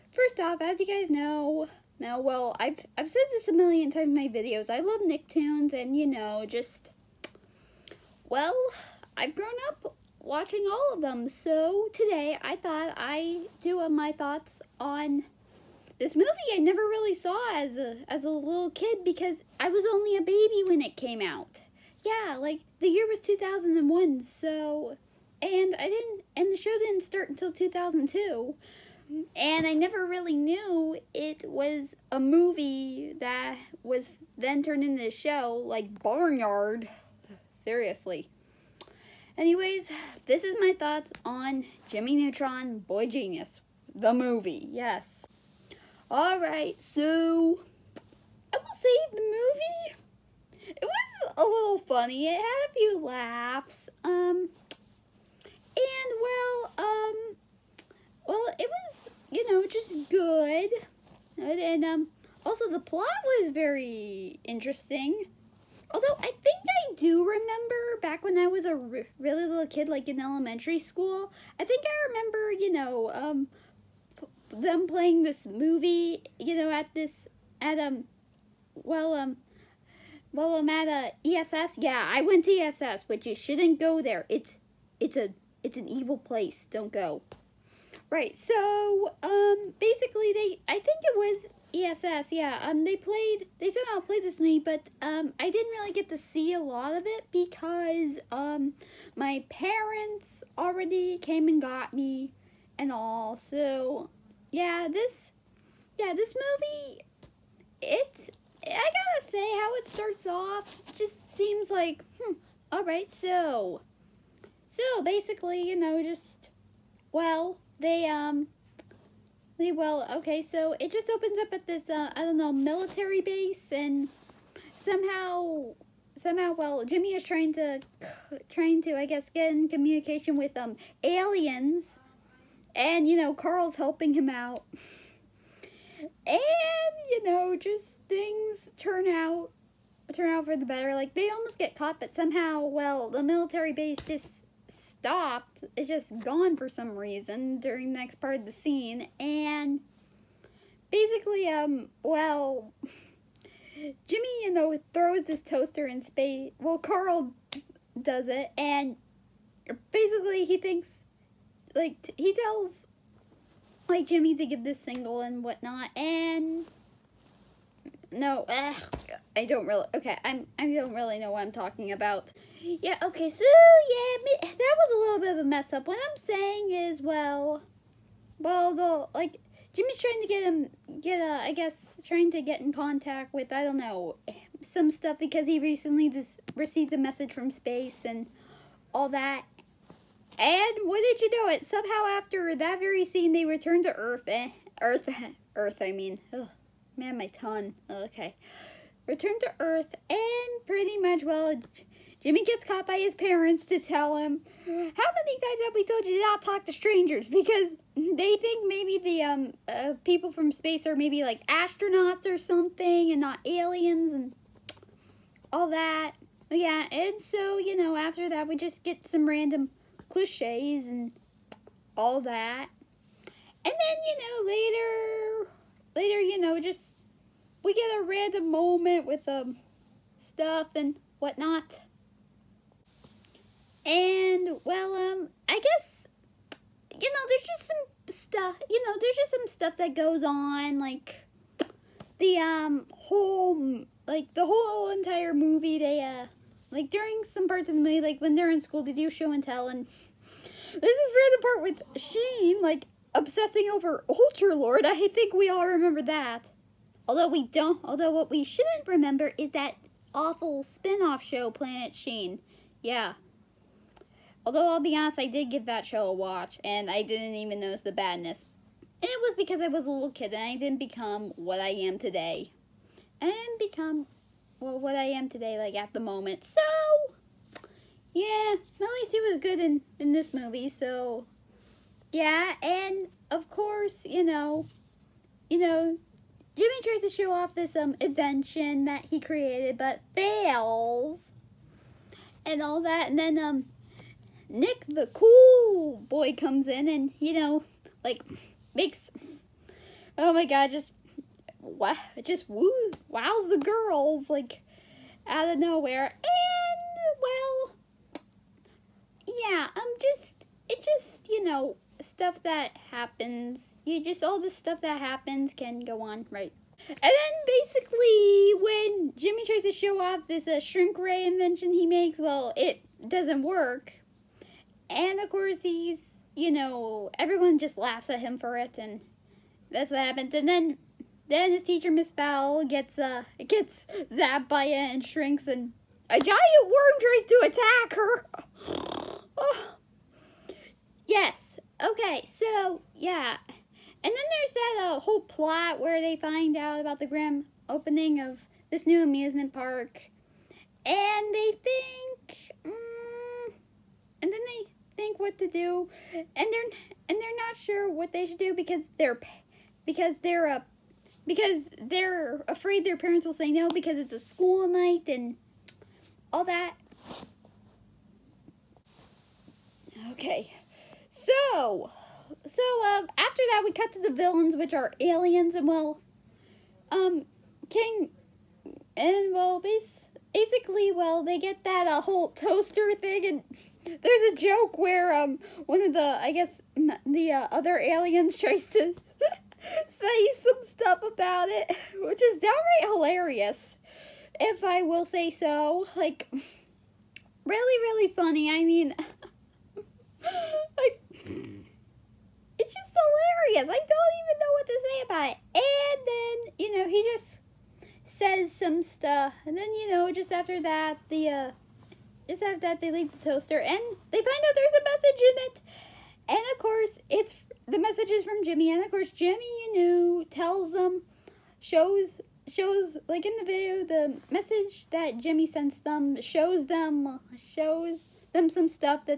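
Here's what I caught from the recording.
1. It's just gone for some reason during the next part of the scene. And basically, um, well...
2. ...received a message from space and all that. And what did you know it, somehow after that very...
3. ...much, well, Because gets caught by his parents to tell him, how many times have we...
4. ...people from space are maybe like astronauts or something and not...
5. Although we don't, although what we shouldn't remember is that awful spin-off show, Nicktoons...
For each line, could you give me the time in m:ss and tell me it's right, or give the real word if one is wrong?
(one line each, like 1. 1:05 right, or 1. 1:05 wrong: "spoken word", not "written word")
1. 2:25 right
2. 3:06 right
3. 3:20 wrong: "Jimmy", not "Because"
4. 3:30 right
5. 4:17 wrong: "Planet", not "Nicktoons".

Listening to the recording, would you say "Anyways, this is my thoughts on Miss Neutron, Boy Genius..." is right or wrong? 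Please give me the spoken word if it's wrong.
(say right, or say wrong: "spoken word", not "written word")
wrong: "Jimmy", not "Miss".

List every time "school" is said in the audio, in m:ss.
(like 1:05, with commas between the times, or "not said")
1:10, 4:08, 6:04.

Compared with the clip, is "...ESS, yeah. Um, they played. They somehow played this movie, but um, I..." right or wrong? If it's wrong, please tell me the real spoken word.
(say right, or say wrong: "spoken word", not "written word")
right.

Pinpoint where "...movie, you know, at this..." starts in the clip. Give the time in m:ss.
1:15.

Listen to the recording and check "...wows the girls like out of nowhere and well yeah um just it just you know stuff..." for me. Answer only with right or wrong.
right.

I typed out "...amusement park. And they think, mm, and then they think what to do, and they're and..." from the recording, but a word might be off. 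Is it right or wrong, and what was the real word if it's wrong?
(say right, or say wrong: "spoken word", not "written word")
right.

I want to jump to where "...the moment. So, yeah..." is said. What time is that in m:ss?
4:35.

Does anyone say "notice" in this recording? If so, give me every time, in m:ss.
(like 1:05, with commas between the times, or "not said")
4:27.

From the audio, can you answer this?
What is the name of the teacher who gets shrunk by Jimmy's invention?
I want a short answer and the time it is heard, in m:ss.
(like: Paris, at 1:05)
Miss Bell, at 5:31.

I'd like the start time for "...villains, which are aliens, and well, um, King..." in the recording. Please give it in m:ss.
6:14.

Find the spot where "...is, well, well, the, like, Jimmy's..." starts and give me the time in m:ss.
2:56.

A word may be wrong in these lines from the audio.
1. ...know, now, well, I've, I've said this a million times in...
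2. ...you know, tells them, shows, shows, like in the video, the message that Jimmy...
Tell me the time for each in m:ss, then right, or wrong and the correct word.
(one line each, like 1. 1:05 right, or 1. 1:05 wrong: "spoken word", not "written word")
1. 0:01 right
2. 6:59 right.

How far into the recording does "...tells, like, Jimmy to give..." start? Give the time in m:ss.
2:42.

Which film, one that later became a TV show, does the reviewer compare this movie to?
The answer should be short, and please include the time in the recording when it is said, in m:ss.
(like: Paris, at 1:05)
Barnyard, at 0:36.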